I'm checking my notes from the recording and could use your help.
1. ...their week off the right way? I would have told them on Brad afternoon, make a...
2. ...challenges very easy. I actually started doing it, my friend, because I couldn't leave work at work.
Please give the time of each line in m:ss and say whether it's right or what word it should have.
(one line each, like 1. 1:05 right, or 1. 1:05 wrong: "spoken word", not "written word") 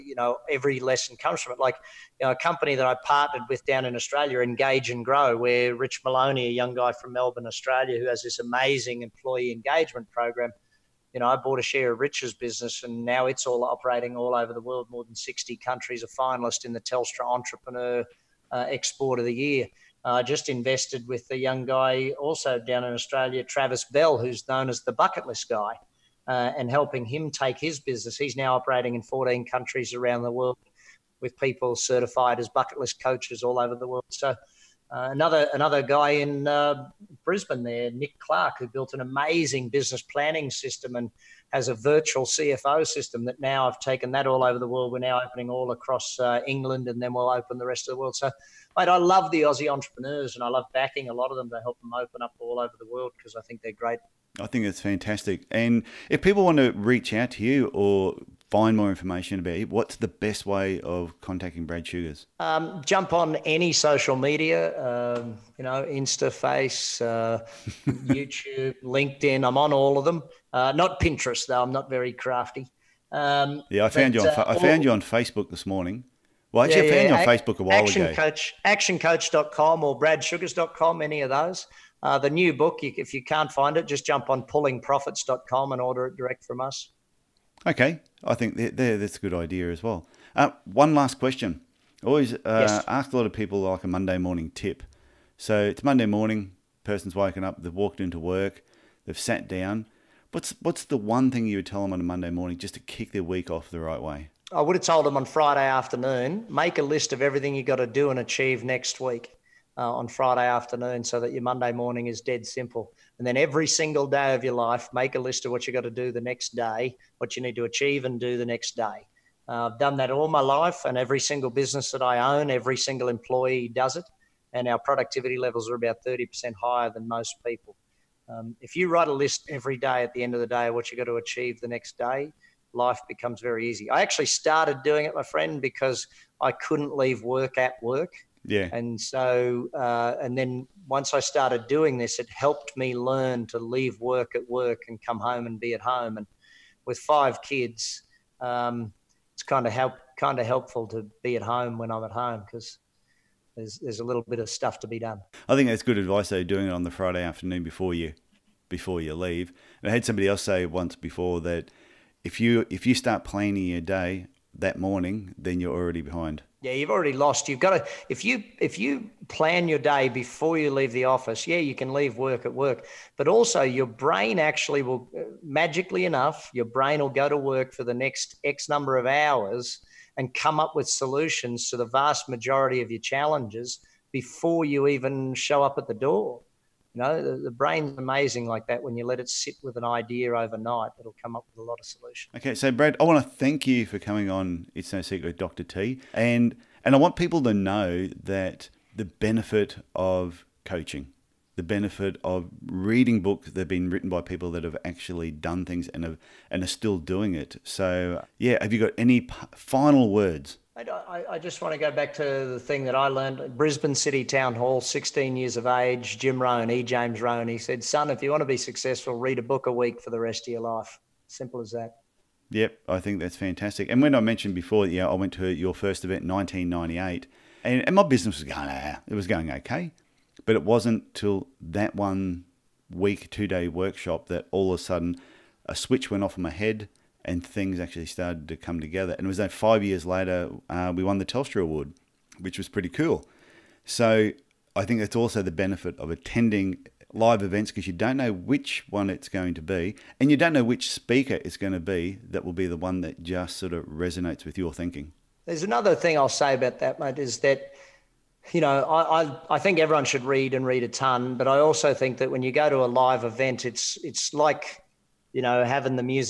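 1. 1:43 wrong: "Friday", not "Brad"
2. 2:13 wrong: "becomes", not "challenges".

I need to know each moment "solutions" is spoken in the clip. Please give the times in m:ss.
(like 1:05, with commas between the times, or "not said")
3:00, 3:11.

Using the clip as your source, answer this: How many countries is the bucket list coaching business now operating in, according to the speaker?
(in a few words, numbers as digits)
14.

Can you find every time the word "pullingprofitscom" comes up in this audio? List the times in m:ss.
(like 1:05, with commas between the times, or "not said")
1:24.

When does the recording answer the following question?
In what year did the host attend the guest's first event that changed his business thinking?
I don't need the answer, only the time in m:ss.
3:46.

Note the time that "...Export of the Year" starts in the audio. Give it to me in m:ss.
0:18.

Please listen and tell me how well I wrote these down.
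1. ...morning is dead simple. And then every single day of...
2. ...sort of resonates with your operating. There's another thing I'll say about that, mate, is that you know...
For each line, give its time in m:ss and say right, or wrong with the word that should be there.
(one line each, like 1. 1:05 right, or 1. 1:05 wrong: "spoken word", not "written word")
1. 1:51 right
2. 4:13 wrong: "thinking", not "operating".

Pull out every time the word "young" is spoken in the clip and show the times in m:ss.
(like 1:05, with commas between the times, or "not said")
0:06, 0:21.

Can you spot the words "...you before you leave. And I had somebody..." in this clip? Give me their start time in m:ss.
2:37.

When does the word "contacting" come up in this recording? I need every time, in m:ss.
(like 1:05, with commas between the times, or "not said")
1:01.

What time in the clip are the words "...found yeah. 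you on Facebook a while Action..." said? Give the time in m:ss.
1:16.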